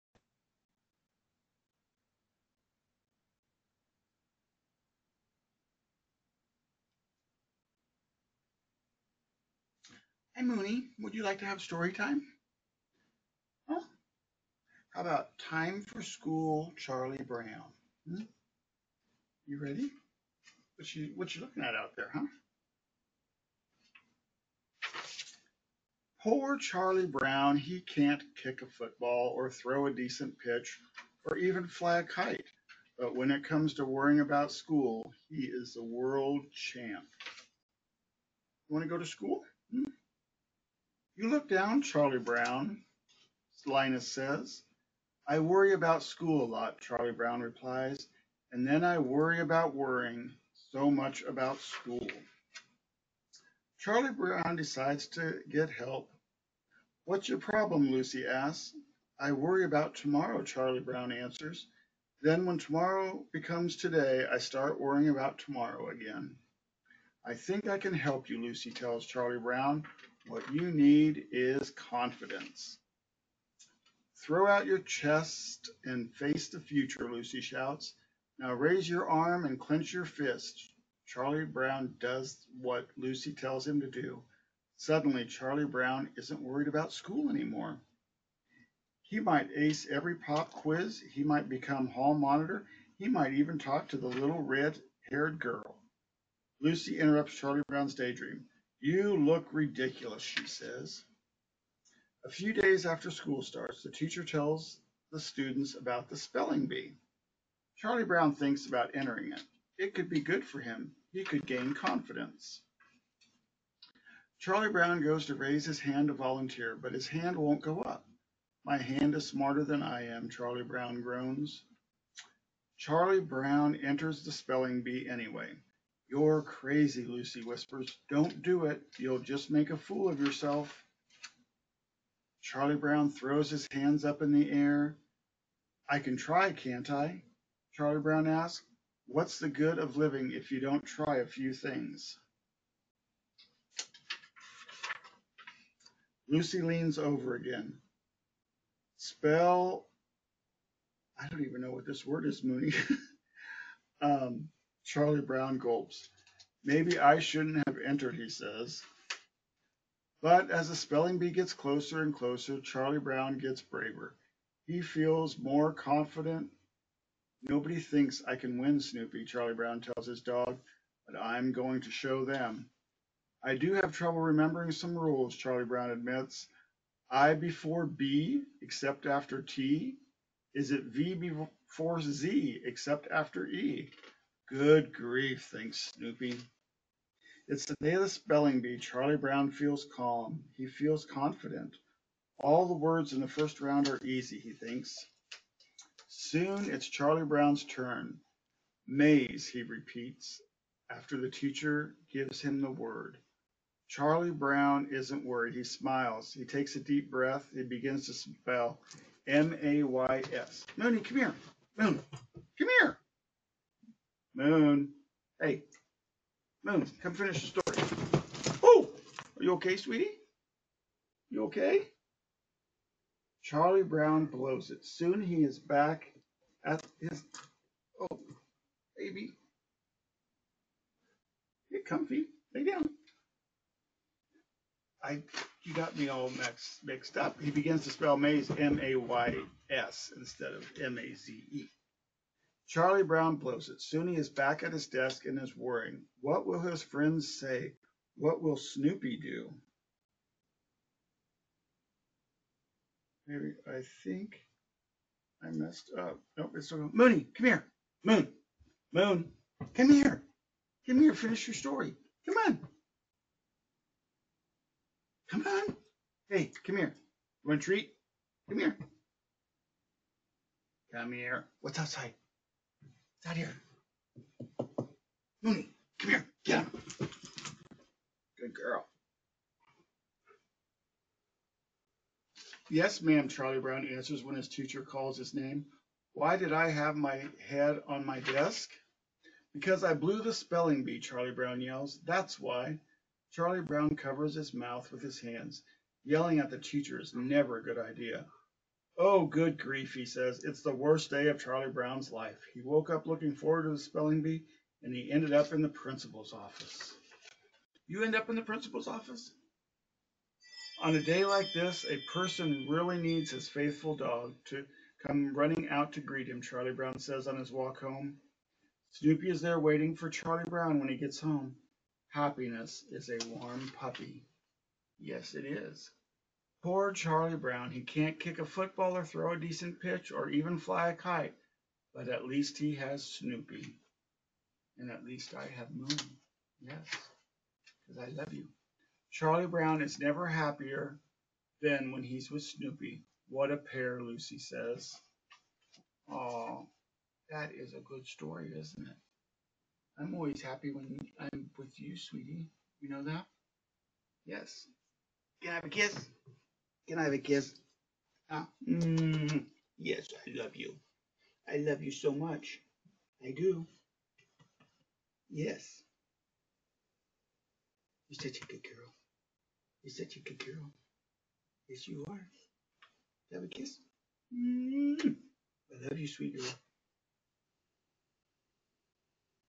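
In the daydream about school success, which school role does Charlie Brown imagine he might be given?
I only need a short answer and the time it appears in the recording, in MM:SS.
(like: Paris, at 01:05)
Hall monitor, at 01:31.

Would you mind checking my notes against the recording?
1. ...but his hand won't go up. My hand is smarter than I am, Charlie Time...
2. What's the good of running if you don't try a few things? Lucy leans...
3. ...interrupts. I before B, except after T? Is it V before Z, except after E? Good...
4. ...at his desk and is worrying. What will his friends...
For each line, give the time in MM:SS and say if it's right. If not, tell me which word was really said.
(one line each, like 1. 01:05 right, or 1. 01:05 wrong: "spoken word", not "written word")
1. 01:56 wrong: "Brown", not "Time"
2. 02:19 wrong: "living", not "running"
3. 02:55 wrong: "admits", not "interrupts"
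4. 04:04 right.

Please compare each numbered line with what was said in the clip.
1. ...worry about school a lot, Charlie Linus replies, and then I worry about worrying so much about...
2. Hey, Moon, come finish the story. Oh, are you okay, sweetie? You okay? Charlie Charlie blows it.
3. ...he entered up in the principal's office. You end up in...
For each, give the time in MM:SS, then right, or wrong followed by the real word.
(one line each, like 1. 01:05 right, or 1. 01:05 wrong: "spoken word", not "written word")
1. 00:45 wrong: "Brown", not "Linus"
2. 03:35 wrong: "Brown", not "Charlie"
3. 05:04 wrong: "ended", not "entered".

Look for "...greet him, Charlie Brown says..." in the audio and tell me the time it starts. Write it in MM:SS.
05:16.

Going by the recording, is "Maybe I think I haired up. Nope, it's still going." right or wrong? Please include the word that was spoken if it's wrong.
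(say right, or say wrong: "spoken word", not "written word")
wrong: "messed", not "haired".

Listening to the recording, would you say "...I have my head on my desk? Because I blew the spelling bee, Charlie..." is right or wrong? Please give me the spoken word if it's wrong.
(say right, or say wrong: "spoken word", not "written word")
right.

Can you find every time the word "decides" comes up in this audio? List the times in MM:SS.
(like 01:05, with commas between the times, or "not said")
00:54.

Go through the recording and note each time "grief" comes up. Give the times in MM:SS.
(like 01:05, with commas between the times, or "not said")
03:04, 04:59.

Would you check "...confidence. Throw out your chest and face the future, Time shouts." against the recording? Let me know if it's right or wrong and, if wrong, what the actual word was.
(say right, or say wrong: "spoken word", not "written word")
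wrong: "Lucy", not "Time".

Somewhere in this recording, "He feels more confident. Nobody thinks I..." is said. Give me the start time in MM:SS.
02:44.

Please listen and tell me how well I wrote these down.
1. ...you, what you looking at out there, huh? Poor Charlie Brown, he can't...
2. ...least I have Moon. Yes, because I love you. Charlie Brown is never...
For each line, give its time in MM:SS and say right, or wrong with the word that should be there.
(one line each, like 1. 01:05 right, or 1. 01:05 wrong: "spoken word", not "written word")
1. 00:20 right
2. 05:35 right.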